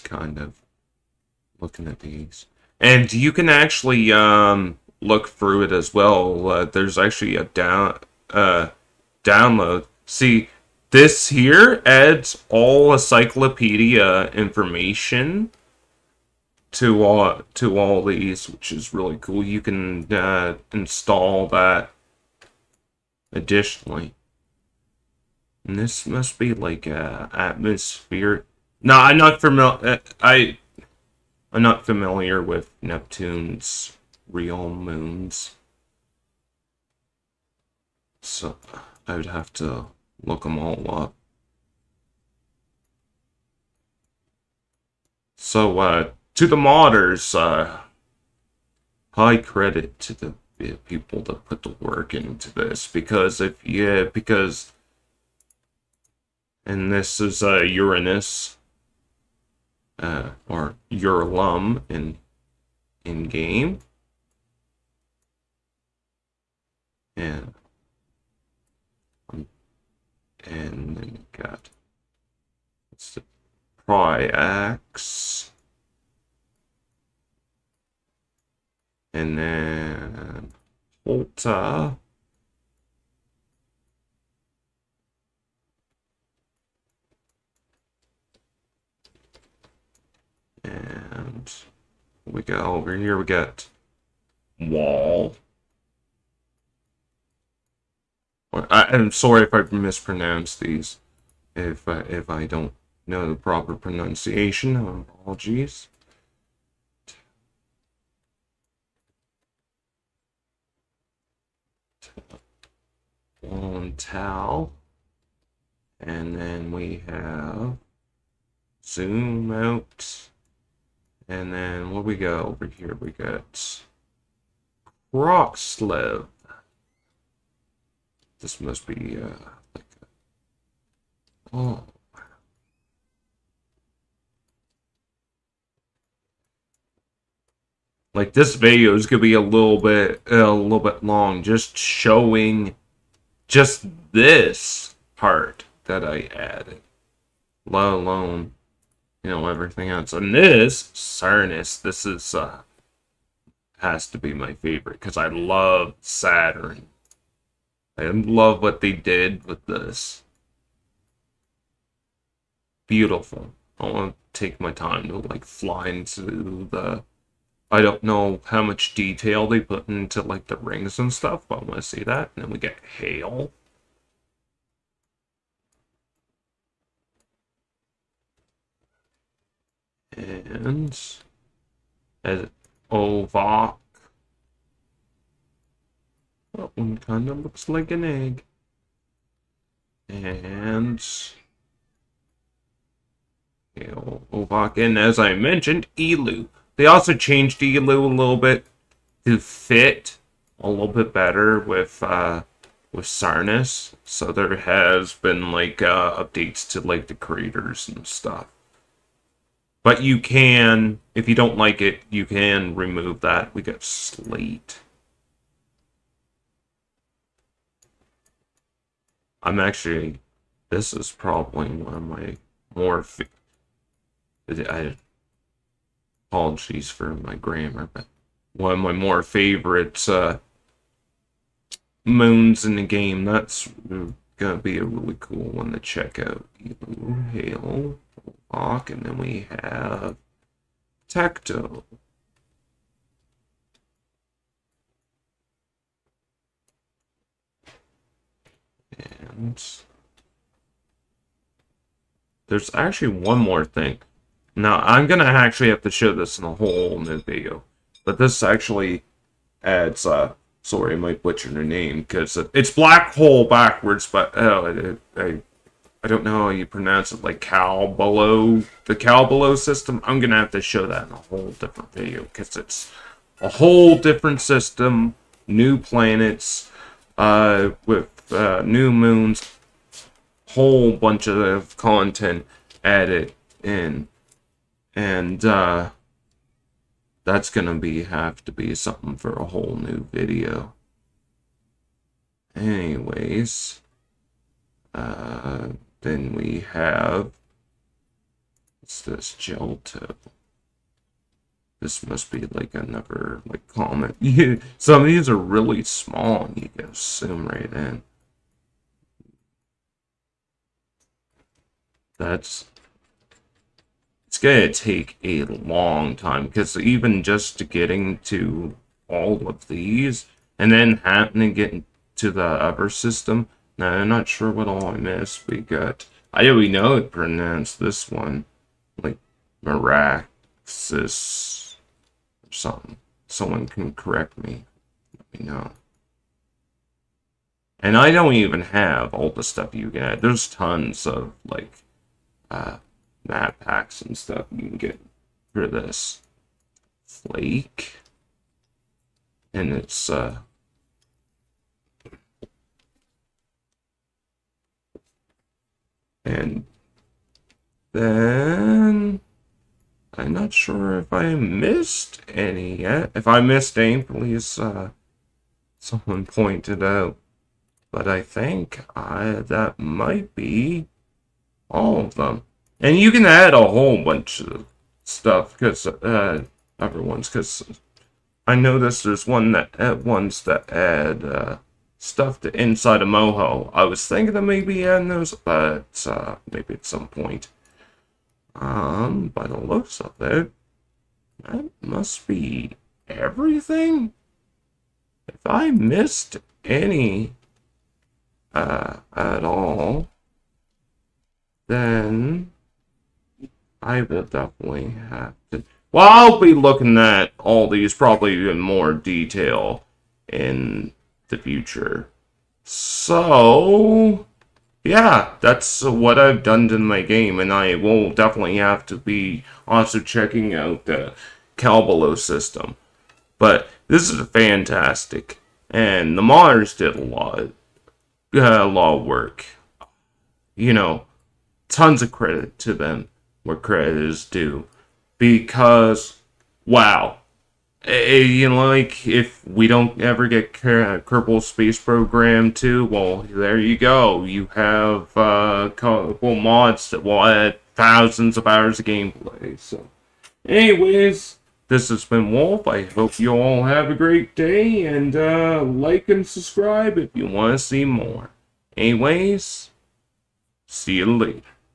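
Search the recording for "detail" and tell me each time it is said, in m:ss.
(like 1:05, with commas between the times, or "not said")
2:48, 6:48.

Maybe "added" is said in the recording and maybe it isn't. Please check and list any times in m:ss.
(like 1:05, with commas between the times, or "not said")
2:26, 4:42.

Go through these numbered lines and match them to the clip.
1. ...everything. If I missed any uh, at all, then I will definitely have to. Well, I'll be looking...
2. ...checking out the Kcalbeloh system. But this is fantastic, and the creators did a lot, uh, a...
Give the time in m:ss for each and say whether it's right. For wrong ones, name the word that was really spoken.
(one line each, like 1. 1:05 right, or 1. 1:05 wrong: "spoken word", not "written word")
1. 6:33 right
2. 6:59 wrong: "modders", not "creators".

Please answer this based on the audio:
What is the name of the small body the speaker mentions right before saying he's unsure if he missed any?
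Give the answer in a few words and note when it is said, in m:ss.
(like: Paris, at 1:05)
Flake, at 5:47.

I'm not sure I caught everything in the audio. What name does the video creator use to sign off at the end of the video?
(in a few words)
Wolf.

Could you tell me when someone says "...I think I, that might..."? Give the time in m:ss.
6:08.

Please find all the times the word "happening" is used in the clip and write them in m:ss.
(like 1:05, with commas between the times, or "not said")
5:21.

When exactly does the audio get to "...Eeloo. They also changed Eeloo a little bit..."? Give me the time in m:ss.
3:15.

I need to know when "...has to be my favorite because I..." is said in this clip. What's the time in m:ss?
2:33.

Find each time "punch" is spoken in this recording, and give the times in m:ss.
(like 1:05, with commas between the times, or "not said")
not said.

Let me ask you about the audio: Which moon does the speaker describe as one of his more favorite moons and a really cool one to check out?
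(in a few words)
Slate.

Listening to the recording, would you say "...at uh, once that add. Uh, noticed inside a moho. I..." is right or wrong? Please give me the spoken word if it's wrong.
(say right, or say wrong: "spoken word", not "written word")
wrong: "stuffed", not "noticed".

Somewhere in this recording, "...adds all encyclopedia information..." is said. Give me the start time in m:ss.
0:11.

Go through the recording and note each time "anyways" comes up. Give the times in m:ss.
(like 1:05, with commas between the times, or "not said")
4:52, 7:30, 7:38.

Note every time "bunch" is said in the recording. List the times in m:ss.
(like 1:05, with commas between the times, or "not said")
4:40, 6:14.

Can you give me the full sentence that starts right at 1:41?
If I, if I don't know the proper pronunciation, of apologies.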